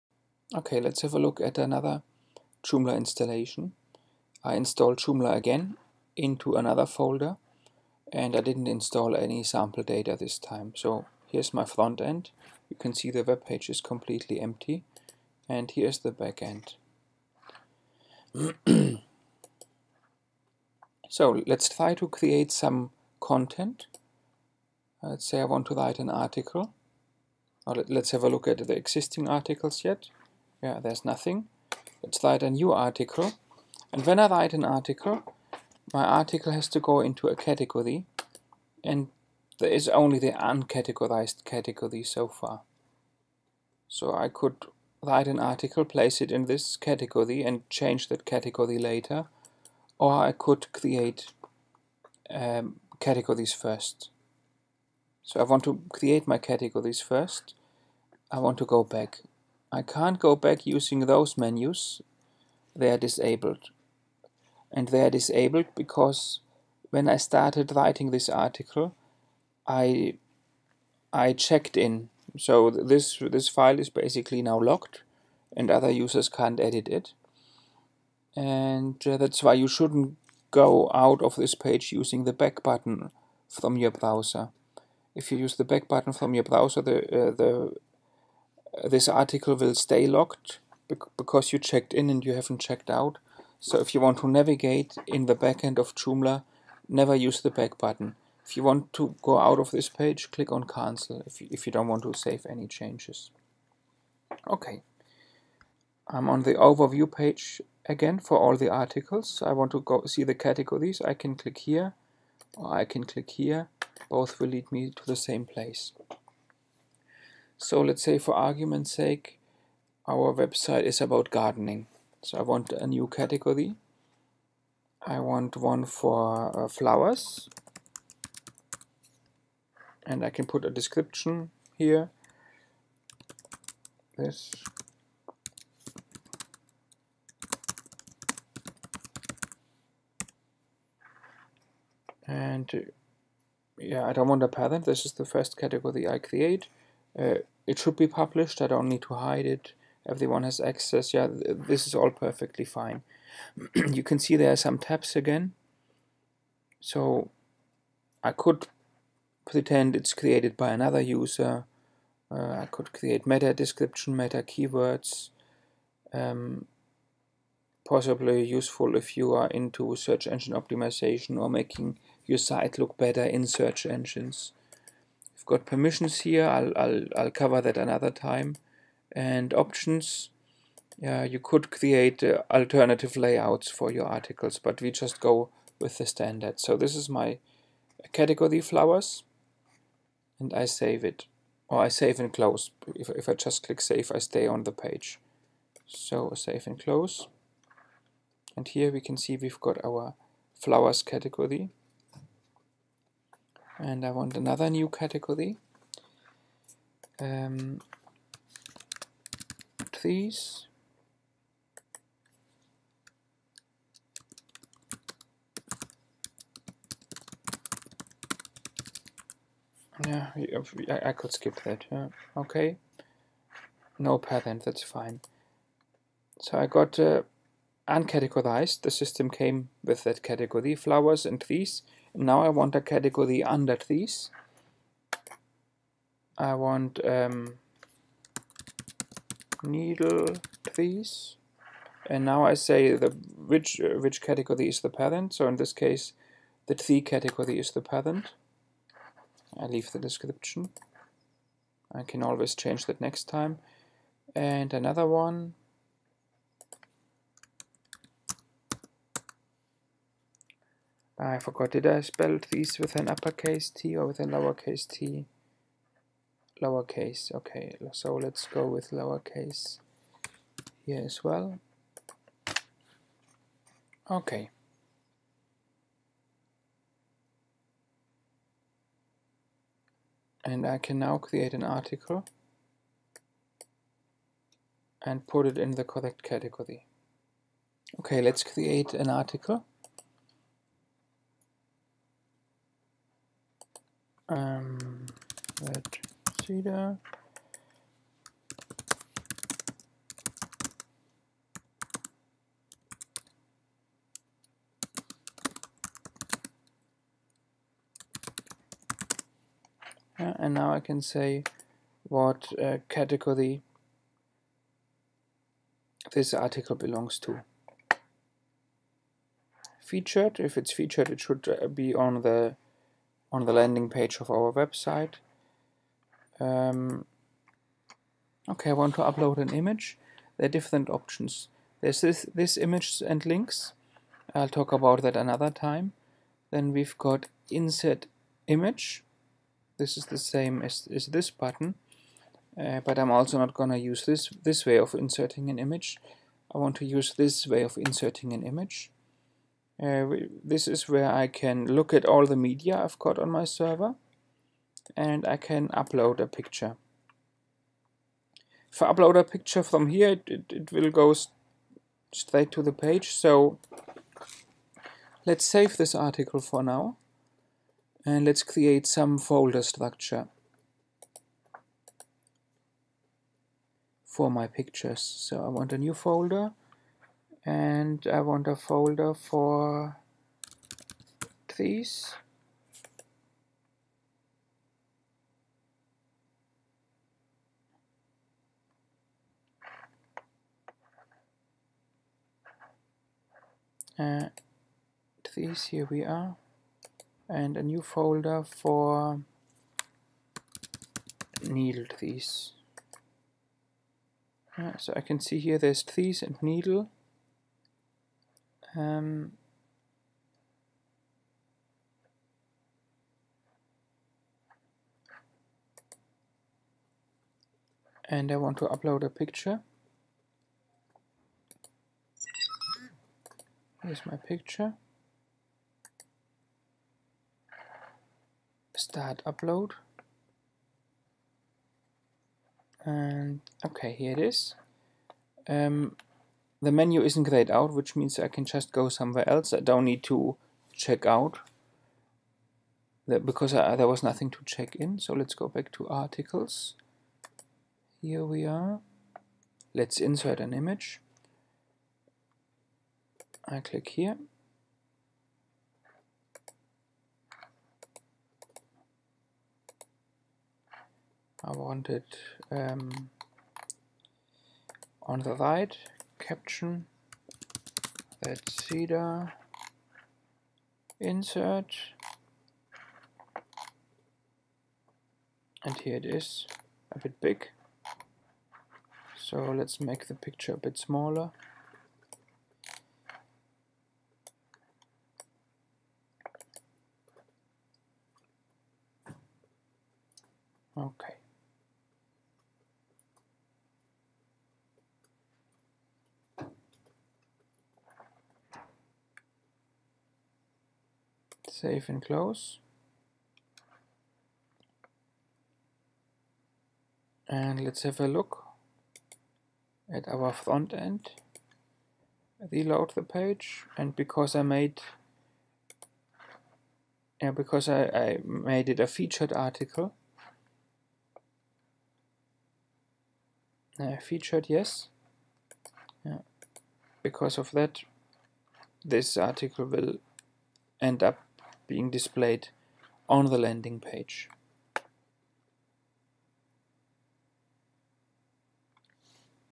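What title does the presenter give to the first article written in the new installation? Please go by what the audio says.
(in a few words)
red cedar.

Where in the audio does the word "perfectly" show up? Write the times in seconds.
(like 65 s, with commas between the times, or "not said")
152 s.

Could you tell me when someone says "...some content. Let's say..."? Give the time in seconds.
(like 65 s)
22 s.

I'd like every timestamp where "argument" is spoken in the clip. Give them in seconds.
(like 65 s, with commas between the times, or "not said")
118 s.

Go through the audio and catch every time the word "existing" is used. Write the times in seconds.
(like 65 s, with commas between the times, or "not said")
28 s.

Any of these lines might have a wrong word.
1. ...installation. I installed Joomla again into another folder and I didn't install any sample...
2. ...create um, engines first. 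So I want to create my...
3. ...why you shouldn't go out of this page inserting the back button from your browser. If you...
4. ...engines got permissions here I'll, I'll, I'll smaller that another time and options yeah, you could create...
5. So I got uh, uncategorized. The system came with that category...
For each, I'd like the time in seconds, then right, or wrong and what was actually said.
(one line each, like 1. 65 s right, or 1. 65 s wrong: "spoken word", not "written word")
1. 2 s right
2. 50 s wrong: "categories", not "engines"
3. 79 s wrong: "using", not "inserting"
4. 173 s wrong: "cover", not "smaller"
5. 226 s right.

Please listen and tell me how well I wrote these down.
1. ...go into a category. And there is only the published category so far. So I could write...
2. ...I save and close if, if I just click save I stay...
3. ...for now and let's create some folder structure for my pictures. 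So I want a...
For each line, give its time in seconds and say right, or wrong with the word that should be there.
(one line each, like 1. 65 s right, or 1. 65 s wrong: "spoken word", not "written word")
1. 36 s wrong: "uncategorized", not "published"
2. 191 s right
3. 366 s right.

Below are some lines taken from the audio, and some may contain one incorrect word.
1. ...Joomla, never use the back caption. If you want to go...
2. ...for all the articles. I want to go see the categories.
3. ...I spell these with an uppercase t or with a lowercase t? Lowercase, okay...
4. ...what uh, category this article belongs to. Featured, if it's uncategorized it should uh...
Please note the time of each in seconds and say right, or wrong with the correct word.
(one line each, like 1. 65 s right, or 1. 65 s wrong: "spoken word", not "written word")
1. 95 s wrong: "button", not "caption"
2. 108 s right
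3. 261 s right
4. 312 s wrong: "featured", not "uncategorized".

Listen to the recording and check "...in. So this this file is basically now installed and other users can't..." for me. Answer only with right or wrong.
wrong.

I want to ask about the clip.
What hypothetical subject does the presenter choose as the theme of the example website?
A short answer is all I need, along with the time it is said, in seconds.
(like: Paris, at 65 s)
gardening, at 121 s.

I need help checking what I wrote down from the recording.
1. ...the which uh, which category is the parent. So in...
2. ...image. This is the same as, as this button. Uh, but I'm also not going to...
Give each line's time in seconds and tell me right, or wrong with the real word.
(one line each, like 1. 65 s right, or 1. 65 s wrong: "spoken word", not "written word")
1. 242 s right
2. 338 s right.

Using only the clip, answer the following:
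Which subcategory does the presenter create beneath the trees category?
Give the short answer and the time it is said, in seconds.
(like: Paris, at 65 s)
needle trees, at 239 s.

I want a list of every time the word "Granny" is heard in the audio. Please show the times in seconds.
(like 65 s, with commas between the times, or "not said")
not said.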